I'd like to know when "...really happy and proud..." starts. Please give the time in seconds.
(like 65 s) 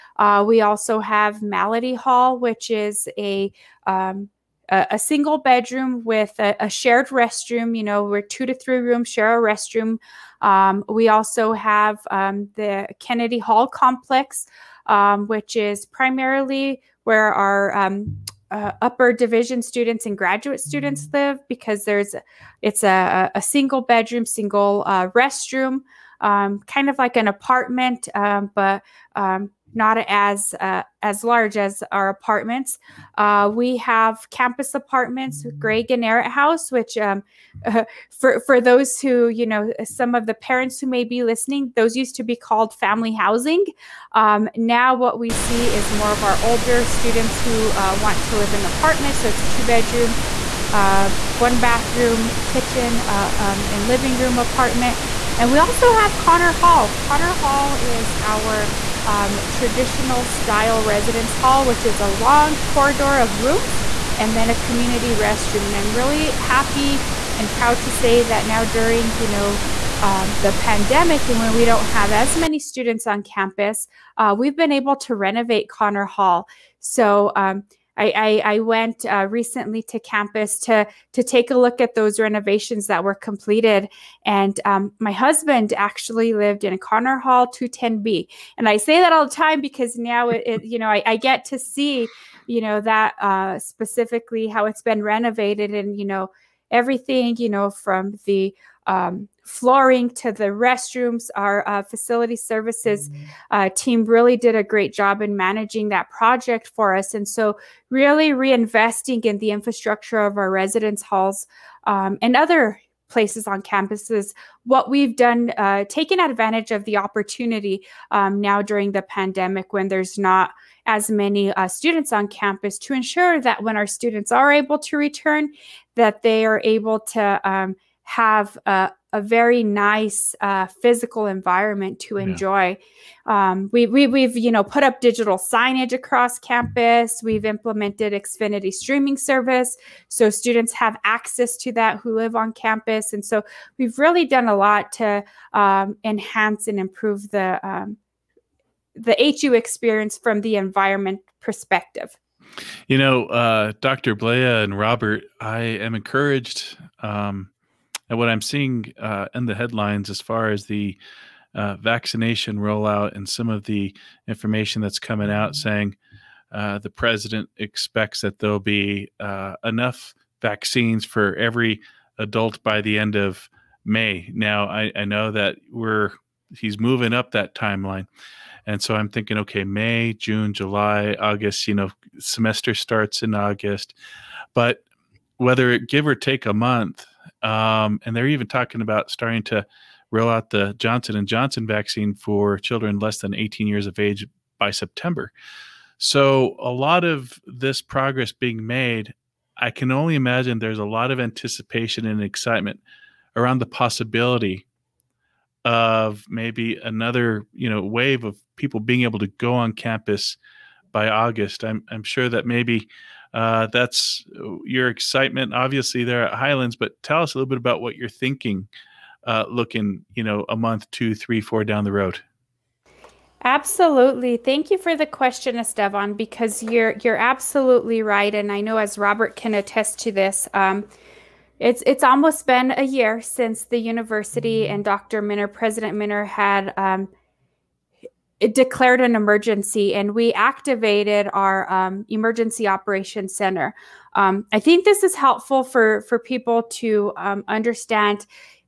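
65 s.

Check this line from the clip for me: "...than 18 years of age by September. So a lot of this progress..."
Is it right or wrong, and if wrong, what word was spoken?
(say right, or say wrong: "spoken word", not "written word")
right.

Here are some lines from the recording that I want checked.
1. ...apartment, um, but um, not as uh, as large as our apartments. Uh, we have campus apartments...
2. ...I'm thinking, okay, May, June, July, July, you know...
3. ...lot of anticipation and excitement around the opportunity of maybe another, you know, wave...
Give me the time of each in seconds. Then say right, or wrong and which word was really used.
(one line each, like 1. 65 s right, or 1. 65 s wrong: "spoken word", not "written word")
1. 27 s right
2. 178 s wrong: "August", not "July"
3. 200 s wrong: "possibility", not "opportunity".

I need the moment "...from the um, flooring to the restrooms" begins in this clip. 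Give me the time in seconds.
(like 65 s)
97 s.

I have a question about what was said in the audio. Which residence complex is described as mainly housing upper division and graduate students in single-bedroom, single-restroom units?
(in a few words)
Kennedy Hall.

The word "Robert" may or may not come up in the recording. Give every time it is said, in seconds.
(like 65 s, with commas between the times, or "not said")
154 s, 228 s.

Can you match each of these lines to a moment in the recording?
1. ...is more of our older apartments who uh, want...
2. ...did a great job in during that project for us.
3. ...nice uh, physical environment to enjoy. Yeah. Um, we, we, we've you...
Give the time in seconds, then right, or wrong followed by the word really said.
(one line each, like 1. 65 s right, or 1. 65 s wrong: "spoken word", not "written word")
1. 45 s wrong: "students", not "apartments"
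2. 104 s wrong: "managing", not "during"
3. 129 s right.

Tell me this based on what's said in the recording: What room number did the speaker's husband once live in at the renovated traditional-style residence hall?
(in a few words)
210B.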